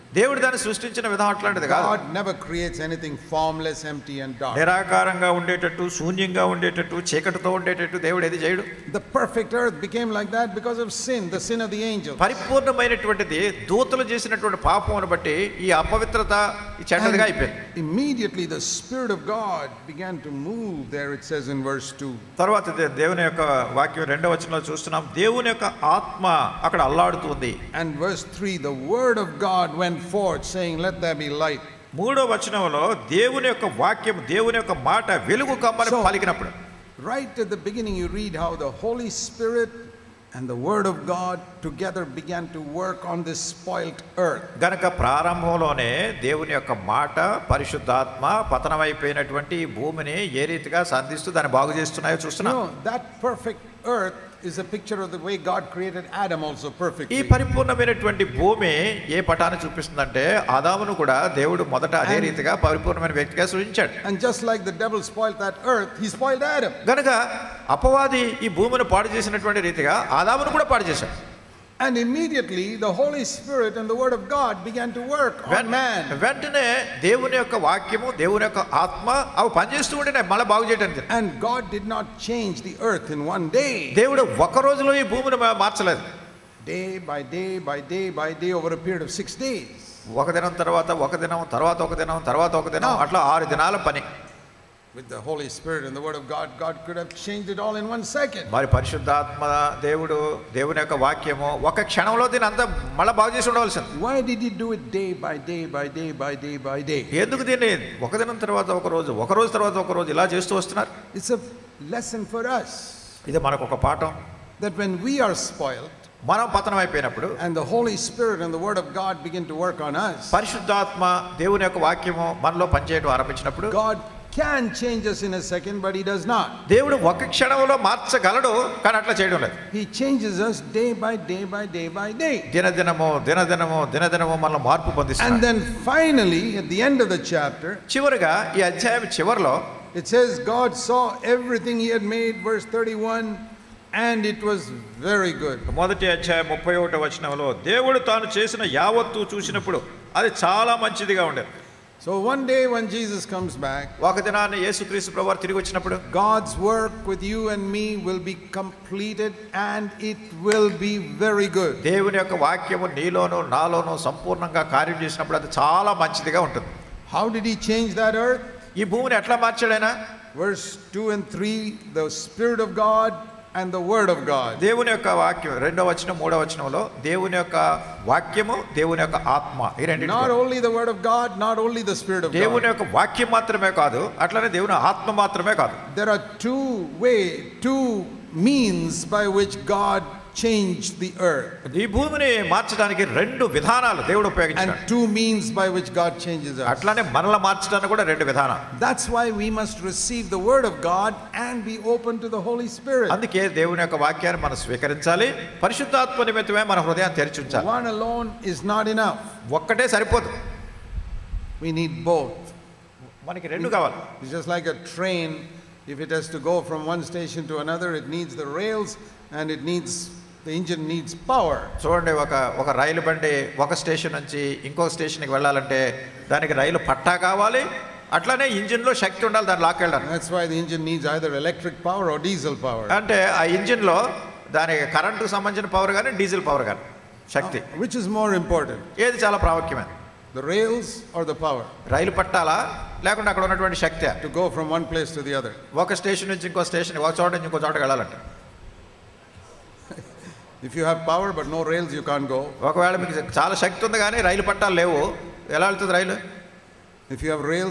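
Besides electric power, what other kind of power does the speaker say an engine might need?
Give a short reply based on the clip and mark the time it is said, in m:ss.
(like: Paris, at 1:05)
Diesel power, at 3:52.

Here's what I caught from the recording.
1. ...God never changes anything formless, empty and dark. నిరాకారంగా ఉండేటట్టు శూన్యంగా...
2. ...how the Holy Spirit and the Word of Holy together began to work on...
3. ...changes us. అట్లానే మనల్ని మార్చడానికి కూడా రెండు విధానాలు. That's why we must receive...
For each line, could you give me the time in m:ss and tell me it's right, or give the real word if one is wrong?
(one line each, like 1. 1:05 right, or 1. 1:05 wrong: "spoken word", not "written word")
1. 0:01 wrong: "creates", not "changes"
2. 0:38 wrong: "God", not "Holy"
3. 3:16 right.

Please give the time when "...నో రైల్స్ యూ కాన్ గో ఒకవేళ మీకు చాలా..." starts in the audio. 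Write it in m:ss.
4:11.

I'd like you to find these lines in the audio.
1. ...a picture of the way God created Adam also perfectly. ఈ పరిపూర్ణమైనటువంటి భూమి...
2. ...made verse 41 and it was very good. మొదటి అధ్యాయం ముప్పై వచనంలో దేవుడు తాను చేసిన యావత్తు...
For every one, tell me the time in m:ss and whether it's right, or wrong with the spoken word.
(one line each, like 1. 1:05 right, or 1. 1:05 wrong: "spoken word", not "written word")
1. 0:54 right
2. 2:22 wrong: "31", not "41".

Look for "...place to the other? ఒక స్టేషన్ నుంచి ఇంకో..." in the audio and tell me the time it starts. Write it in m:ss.
4:04.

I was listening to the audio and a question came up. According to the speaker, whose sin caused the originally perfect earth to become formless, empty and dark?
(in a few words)
The angels.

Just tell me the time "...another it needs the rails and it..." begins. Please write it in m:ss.
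3:37.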